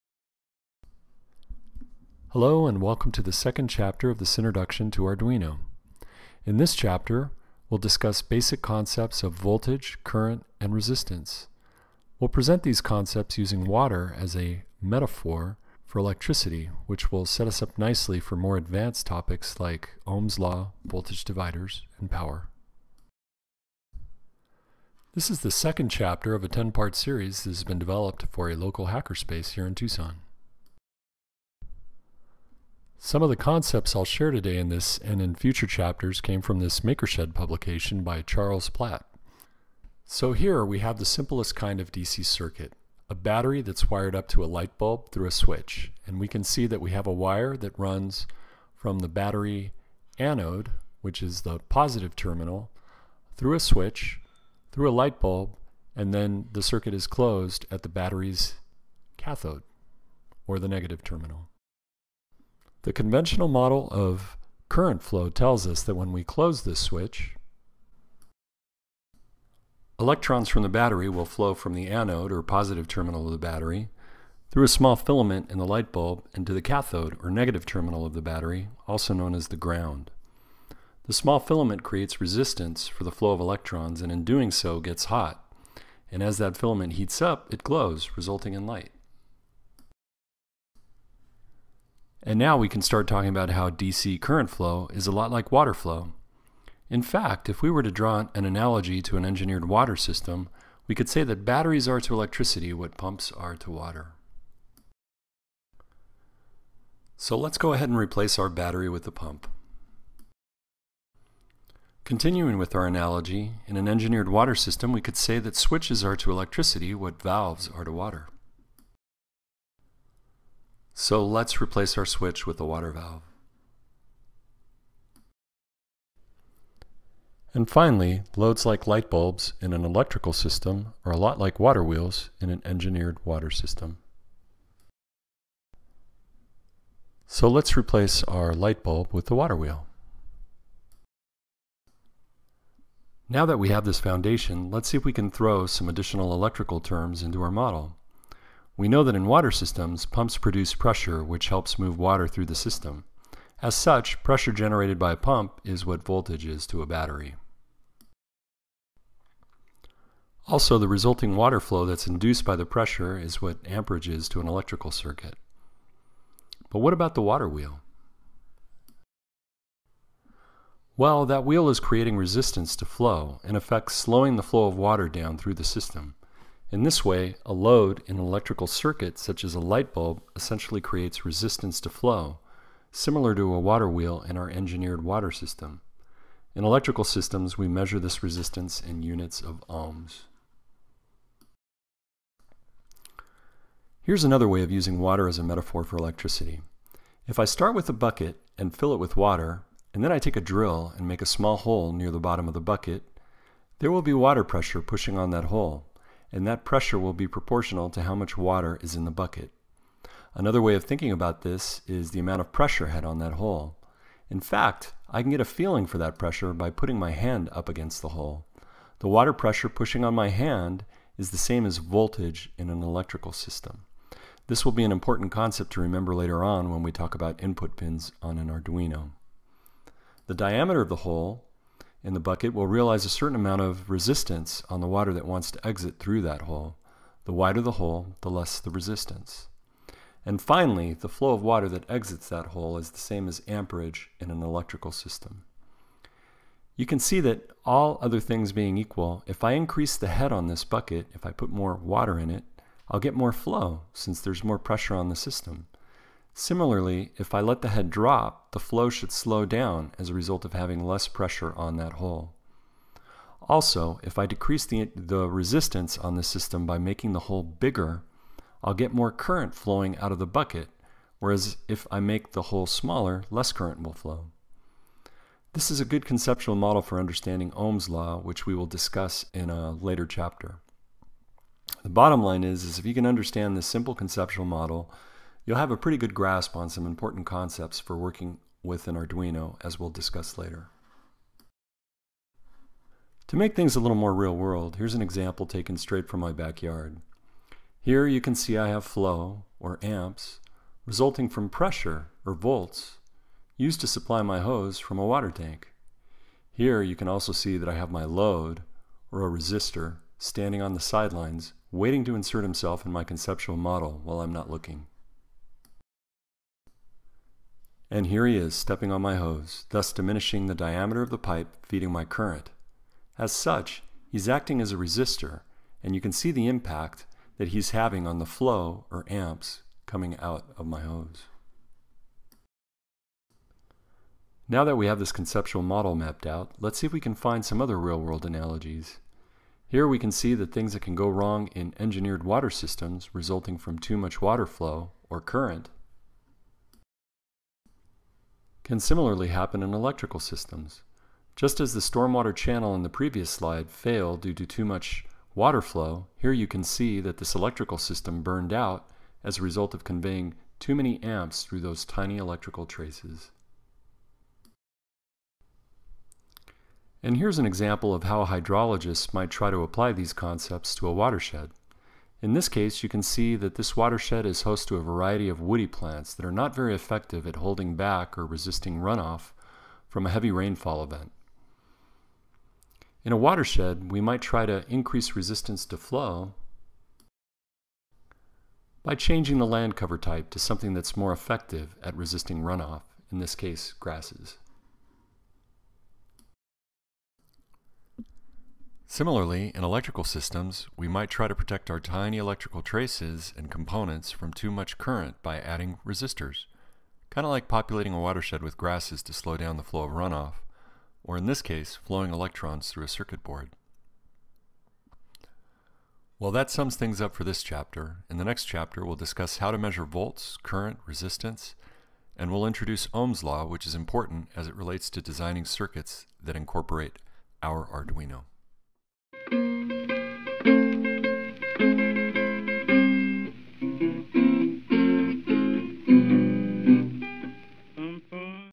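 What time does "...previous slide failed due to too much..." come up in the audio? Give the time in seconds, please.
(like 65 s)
352 s.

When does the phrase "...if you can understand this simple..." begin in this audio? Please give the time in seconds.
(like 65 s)
282 s.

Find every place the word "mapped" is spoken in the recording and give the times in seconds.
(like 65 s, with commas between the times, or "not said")
335 s.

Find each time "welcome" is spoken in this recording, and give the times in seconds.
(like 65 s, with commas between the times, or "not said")
2 s.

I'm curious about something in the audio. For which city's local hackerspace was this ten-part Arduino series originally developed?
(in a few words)
Tucson.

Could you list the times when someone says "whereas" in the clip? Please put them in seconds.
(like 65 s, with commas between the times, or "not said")
271 s.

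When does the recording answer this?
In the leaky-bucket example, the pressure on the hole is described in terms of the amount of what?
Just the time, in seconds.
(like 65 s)
212 s.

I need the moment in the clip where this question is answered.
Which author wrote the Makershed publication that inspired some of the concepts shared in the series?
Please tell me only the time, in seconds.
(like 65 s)
38 s.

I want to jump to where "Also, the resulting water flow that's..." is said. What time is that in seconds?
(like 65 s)
160 s.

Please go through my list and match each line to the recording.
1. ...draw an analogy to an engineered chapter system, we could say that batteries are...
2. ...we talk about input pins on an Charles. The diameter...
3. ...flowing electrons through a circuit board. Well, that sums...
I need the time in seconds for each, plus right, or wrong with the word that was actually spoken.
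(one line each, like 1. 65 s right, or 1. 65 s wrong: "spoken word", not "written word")
1. 97 s wrong: "water", not "chapter"
2. 226 s wrong: "Arduino", not "Charles"
3. 411 s right.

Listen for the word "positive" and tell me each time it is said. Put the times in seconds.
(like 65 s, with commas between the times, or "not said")
51 s, 72 s.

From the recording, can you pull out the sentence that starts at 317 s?
And here he is stepping on my hose, thus diminishing the diameter of the pipe feeding my current.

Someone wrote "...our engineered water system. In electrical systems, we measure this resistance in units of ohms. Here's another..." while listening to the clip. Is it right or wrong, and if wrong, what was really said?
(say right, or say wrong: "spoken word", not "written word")
right.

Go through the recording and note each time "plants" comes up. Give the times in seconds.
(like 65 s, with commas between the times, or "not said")
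375 s.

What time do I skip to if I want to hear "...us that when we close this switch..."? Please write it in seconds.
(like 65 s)
65 s.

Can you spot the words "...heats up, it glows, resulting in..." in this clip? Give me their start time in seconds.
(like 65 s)
86 s.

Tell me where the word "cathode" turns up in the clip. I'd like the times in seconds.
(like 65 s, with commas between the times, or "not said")
59 s, 76 s.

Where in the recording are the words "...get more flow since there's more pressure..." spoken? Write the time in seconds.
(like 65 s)
252 s.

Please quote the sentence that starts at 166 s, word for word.
But what about the water wheel?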